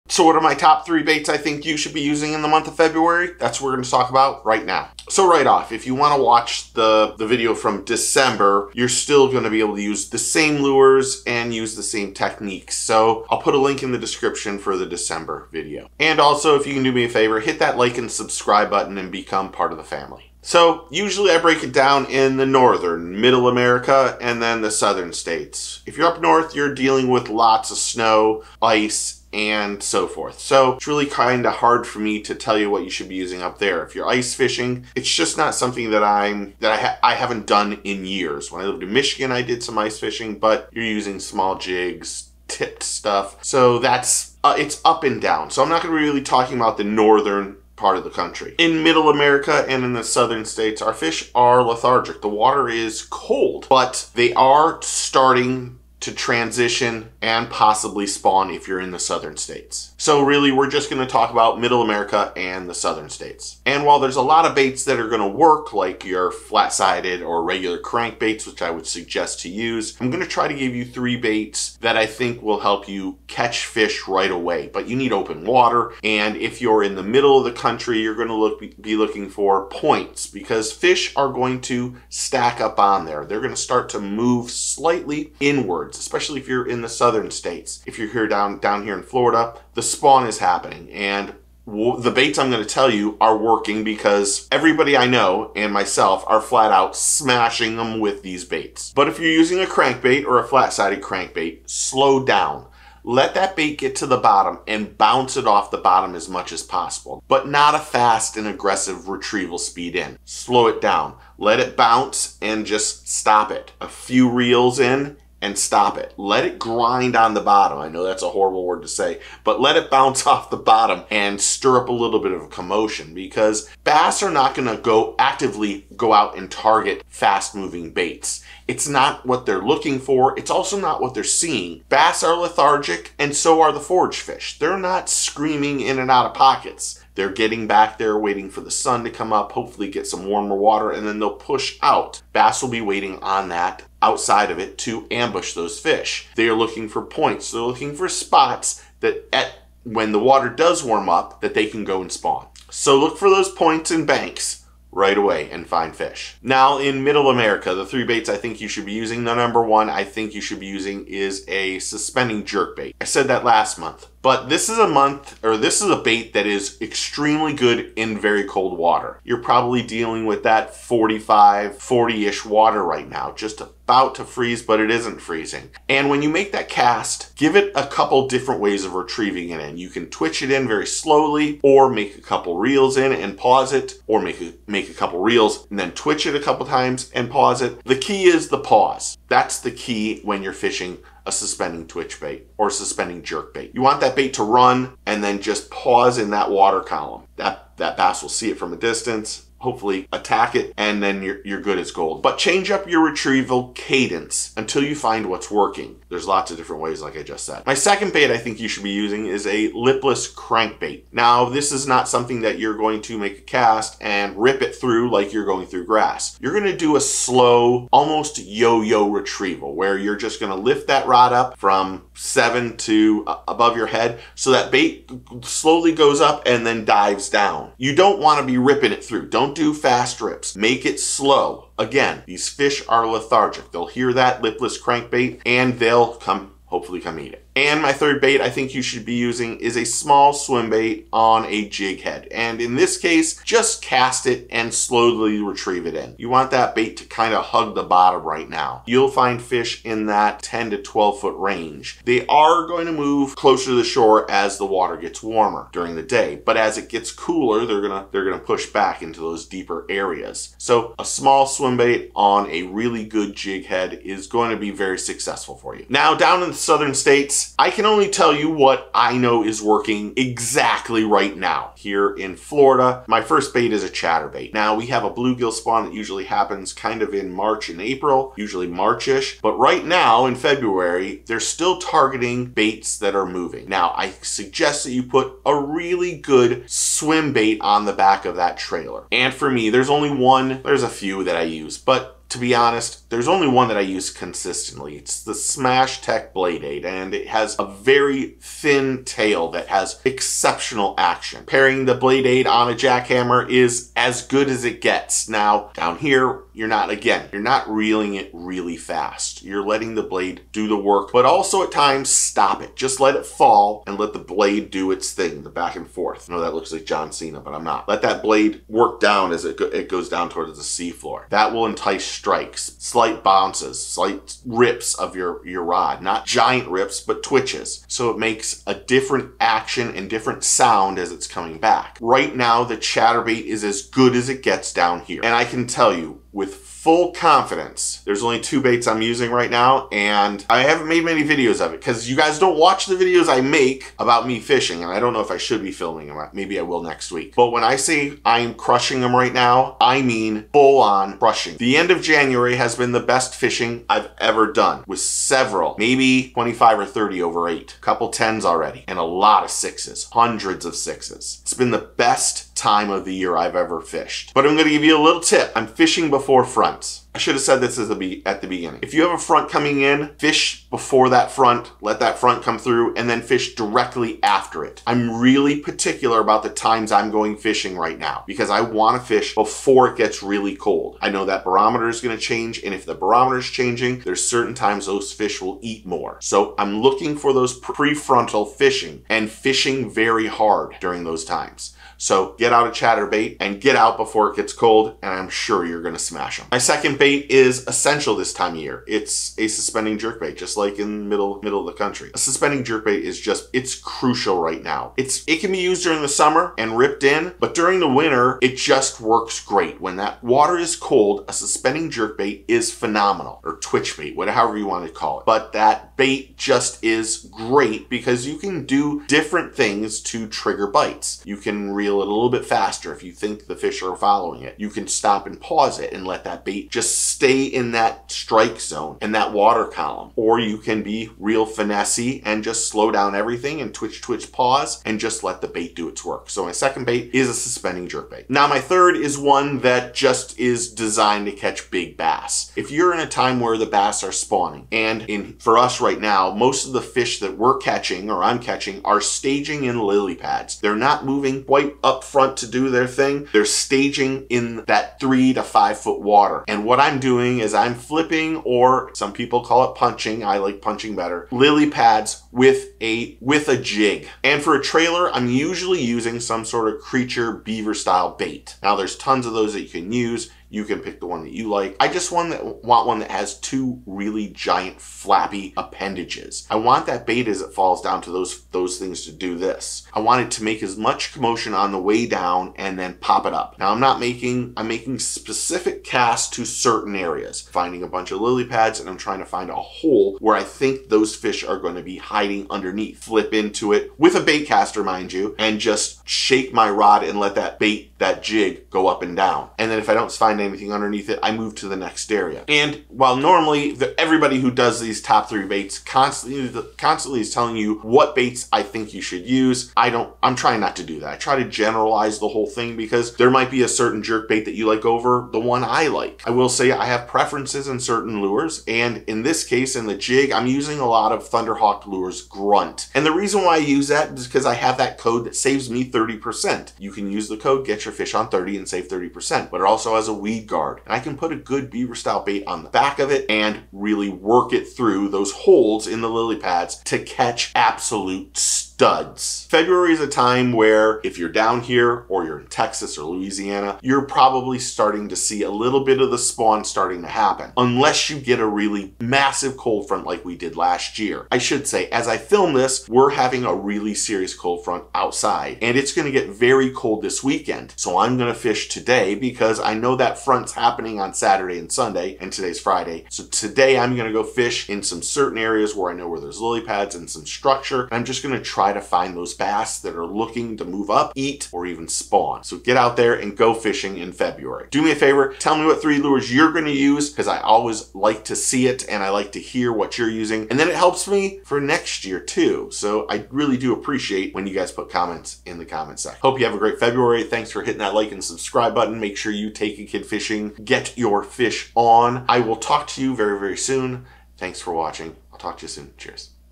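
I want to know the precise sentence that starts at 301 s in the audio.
Pairing the Blade 8 on a jackhammer is as good as it gets.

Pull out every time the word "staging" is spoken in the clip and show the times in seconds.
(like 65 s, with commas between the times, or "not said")
449 s, 453 s.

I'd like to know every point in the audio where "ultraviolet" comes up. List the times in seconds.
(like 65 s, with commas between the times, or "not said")
not said.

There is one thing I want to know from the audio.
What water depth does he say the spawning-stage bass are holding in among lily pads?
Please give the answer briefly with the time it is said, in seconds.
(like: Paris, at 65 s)
3 to 5 feet, at 454 s.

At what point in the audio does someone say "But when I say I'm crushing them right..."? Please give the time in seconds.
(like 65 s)
347 s.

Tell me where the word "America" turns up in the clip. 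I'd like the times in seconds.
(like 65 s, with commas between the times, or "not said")
23 s, 49 s, 61 s, 157 s.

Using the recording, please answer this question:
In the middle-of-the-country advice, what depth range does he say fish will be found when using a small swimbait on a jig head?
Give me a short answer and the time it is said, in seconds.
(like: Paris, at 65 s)
10 to 12 feet, at 250 s.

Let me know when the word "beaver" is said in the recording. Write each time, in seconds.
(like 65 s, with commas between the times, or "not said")
467 s, 531 s.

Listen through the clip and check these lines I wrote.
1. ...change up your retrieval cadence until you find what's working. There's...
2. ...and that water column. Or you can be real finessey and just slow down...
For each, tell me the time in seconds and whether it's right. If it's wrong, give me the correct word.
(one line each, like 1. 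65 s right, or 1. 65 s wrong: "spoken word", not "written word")
1. 202 s right
2. 429 s right.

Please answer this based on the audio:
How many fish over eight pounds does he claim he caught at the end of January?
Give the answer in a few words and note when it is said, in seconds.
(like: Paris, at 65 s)
25 or 30, at 356 s.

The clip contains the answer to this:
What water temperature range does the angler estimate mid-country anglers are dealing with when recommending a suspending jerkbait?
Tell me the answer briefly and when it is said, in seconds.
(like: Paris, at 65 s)
45, 40-ish, at 170 s.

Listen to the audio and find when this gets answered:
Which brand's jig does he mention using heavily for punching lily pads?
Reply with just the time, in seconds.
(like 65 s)
521 s.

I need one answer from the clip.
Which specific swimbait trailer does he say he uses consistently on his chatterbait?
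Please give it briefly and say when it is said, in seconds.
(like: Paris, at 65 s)
Smash Tech Blade 8, at 295 s.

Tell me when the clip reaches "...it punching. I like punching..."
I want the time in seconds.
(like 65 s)
459 s.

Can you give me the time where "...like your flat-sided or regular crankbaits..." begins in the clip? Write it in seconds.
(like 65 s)
65 s.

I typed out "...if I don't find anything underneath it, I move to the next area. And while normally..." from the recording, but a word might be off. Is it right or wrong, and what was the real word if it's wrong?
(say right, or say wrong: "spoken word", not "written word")
right.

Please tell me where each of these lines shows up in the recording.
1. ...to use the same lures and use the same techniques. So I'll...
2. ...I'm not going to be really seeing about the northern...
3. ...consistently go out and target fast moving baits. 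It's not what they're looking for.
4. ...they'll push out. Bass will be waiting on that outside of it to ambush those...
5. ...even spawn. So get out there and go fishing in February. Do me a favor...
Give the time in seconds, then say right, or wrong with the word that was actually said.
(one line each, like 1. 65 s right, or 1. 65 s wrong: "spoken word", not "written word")
1. 9 s right
2. 45 s wrong: "talking", not "seeing"
3. 125 s wrong: "actively", not "consistently"
4. 141 s right
5. 571 s right.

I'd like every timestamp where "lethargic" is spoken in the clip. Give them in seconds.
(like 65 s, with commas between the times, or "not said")
51 s, 132 s, 233 s.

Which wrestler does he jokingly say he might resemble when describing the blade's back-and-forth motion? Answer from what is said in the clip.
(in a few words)
John Cena.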